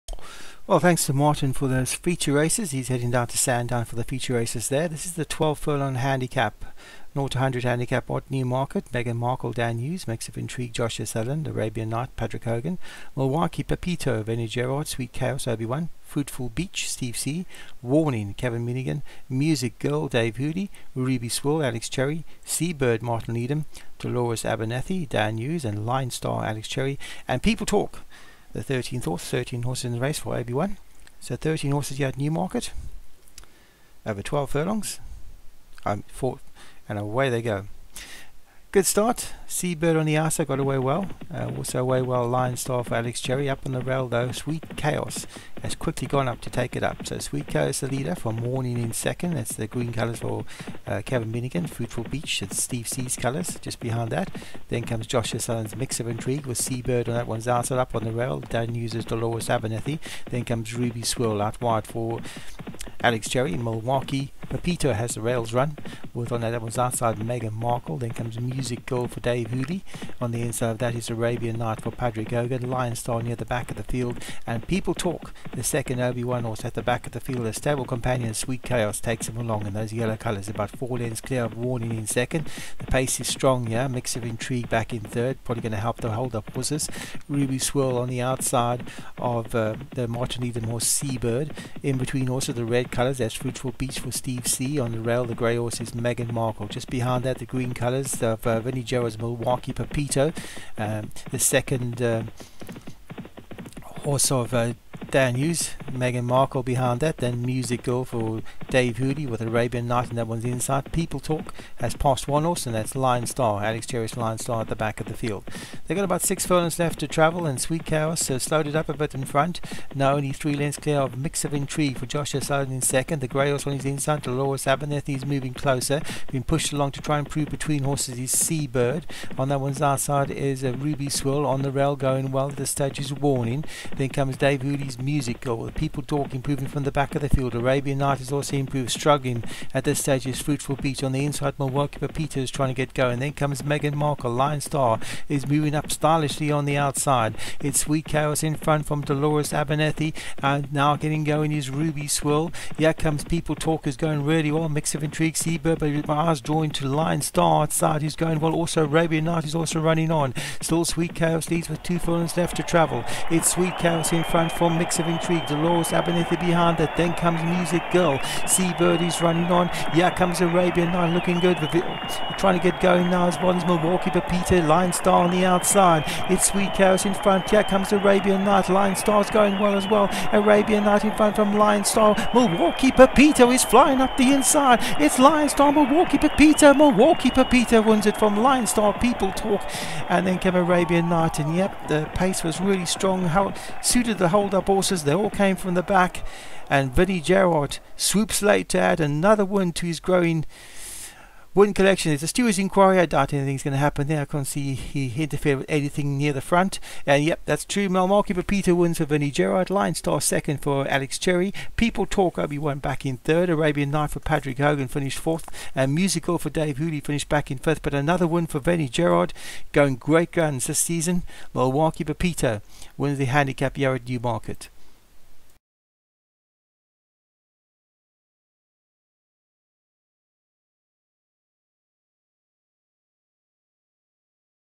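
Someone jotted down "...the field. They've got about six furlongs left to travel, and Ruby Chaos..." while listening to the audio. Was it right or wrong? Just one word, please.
wrong.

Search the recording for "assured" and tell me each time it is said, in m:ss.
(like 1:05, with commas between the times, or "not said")
not said.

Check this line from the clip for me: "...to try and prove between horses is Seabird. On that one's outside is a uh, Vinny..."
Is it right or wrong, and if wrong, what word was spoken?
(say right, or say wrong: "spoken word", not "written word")
wrong: "Ruby", not "Vinny".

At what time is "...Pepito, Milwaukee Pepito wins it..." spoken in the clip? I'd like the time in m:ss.
3:06.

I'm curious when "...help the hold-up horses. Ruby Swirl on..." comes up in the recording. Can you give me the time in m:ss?
1:25.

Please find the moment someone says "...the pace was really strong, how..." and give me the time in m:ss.
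3:11.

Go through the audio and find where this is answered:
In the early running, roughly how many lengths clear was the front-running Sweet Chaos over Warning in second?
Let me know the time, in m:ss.
1:20.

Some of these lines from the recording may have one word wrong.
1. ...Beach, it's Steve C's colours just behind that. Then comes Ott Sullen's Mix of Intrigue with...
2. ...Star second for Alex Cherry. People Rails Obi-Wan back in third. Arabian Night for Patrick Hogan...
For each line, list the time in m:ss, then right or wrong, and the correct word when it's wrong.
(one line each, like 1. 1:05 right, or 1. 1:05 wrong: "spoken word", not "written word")
1. 0:52 wrong: "Joshua", not "Ott"
2. 3:29 wrong: "Talk", not "Rails".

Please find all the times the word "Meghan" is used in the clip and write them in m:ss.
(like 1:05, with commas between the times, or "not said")
0:08, 1:07, 1:35, 1:45, 2:23.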